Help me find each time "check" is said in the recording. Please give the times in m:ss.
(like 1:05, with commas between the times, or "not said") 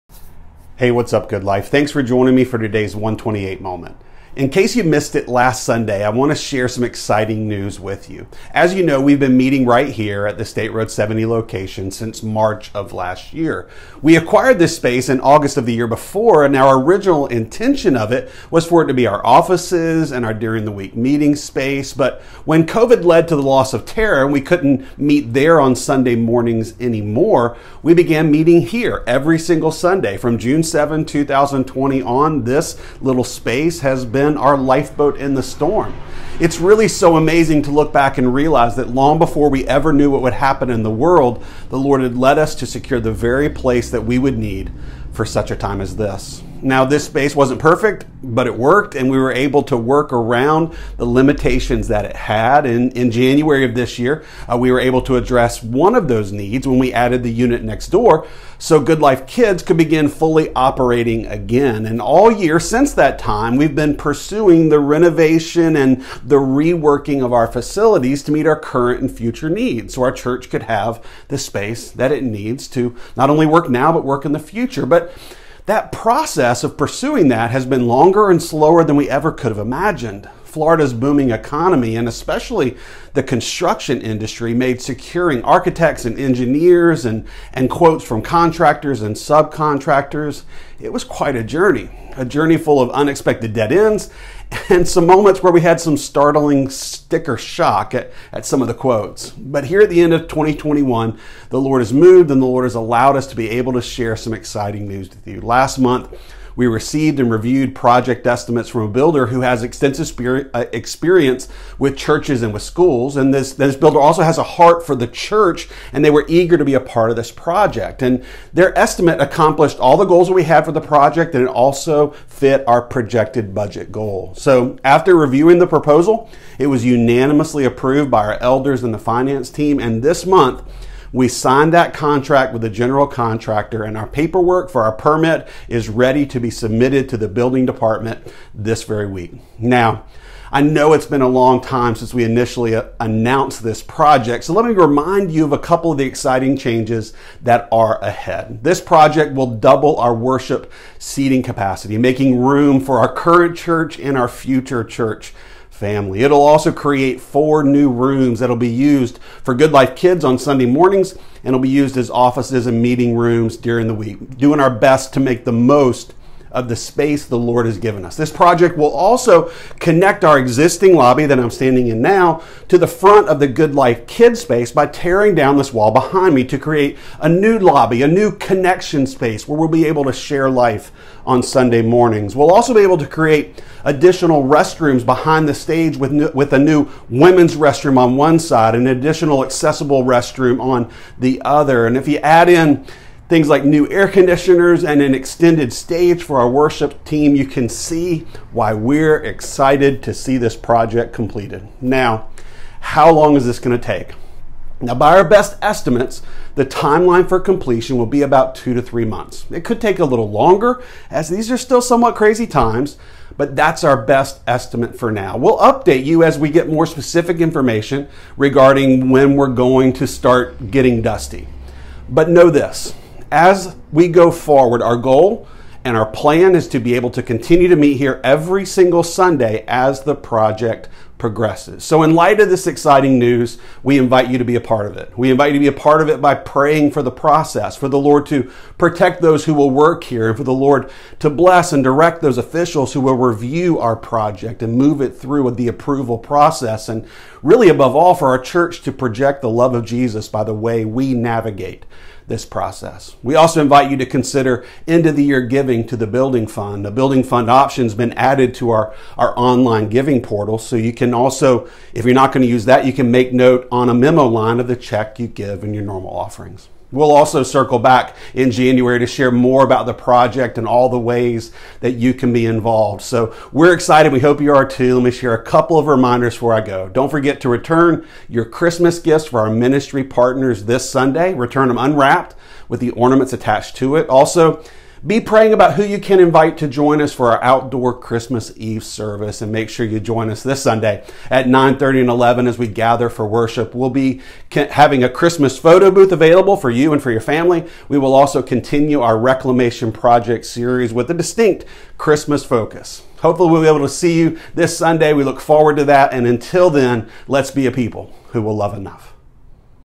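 4:24.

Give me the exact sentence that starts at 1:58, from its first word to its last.
And their estimate accomplished all the goals that we had for the project, and it also fit our projected budget goal.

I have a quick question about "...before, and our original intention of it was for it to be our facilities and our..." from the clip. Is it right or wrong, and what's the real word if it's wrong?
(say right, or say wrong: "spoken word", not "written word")
wrong: "offices", not "facilities".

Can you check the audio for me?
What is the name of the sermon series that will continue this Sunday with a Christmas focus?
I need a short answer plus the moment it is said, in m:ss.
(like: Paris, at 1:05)
reclamation project, at 4:59.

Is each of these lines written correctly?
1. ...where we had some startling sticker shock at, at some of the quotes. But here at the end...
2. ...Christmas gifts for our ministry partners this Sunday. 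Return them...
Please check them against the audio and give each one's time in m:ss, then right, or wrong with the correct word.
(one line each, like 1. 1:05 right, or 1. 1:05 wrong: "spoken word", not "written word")
1. 1:35 right
2. 4:38 right.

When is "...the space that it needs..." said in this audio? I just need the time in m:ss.
1:11.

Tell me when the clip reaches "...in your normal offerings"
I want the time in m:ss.
4:25.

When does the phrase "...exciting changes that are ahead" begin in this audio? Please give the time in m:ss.
2:26.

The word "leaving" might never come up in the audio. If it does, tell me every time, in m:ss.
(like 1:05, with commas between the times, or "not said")
not said.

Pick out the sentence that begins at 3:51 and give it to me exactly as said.
So, in light of this exciting news, we invite you to be a part of it.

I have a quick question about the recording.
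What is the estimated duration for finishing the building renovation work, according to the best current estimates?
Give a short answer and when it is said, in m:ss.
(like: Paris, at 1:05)
2 to 3 months, at 3:28.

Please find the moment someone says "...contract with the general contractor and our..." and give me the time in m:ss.
2:11.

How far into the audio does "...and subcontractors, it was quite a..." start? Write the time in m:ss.
1:29.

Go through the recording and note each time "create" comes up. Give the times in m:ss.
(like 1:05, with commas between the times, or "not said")
2:36, 2:56, 3:03.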